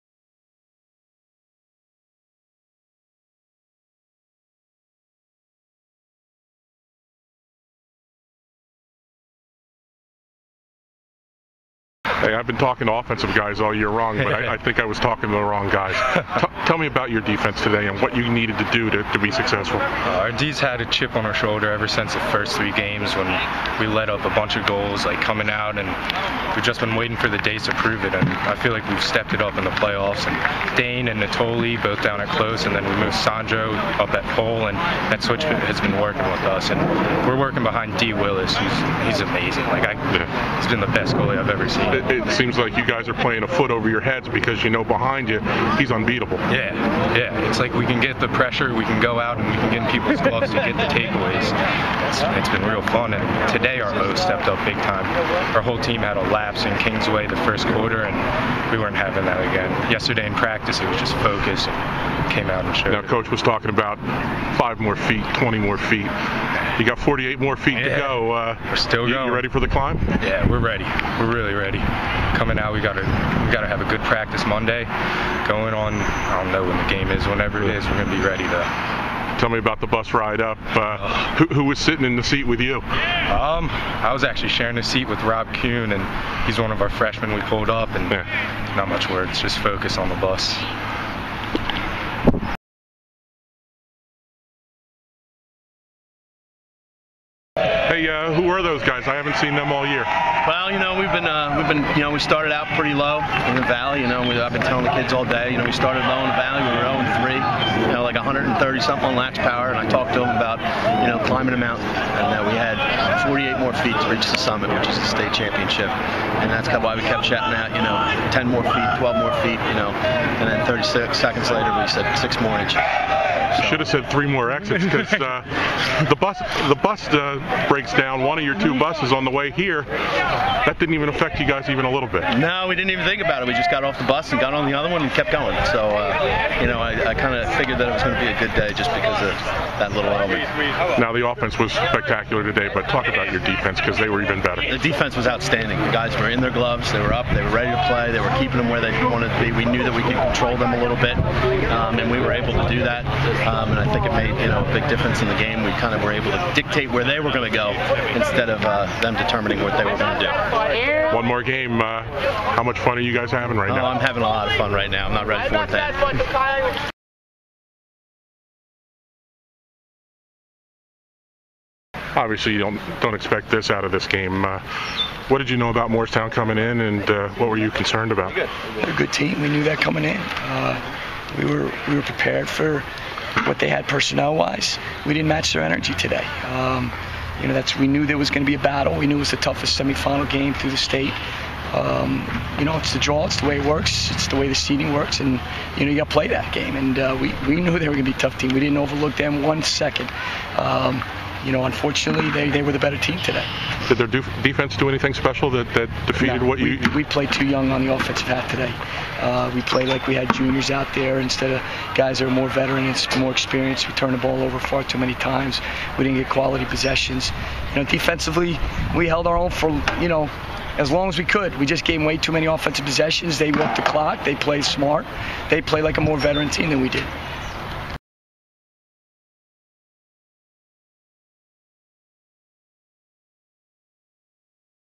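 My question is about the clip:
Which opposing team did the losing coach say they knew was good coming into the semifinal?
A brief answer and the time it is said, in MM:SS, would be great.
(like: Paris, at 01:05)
Moorestown, at 02:55.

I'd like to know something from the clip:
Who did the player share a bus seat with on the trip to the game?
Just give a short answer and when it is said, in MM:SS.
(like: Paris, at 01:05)
Rob Kuhn, at 01:25.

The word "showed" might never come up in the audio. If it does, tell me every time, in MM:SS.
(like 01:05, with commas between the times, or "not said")
01:02.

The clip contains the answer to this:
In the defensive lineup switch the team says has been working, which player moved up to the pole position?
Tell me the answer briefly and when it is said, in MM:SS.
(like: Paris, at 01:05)
Sandro, at 00:33.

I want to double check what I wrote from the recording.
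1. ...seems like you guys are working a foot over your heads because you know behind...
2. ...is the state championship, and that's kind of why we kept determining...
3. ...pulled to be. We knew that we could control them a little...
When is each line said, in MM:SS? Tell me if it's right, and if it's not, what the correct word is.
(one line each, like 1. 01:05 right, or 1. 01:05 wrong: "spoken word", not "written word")
1. 00:42 wrong: "playing", not "working"
2. 01:54 wrong: "chatting", not "determining"
3. 02:29 wrong: "wanted", not "pulled".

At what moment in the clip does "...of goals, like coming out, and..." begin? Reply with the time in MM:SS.
00:24.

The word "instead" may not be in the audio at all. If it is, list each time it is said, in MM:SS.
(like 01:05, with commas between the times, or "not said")
02:38, 03:31.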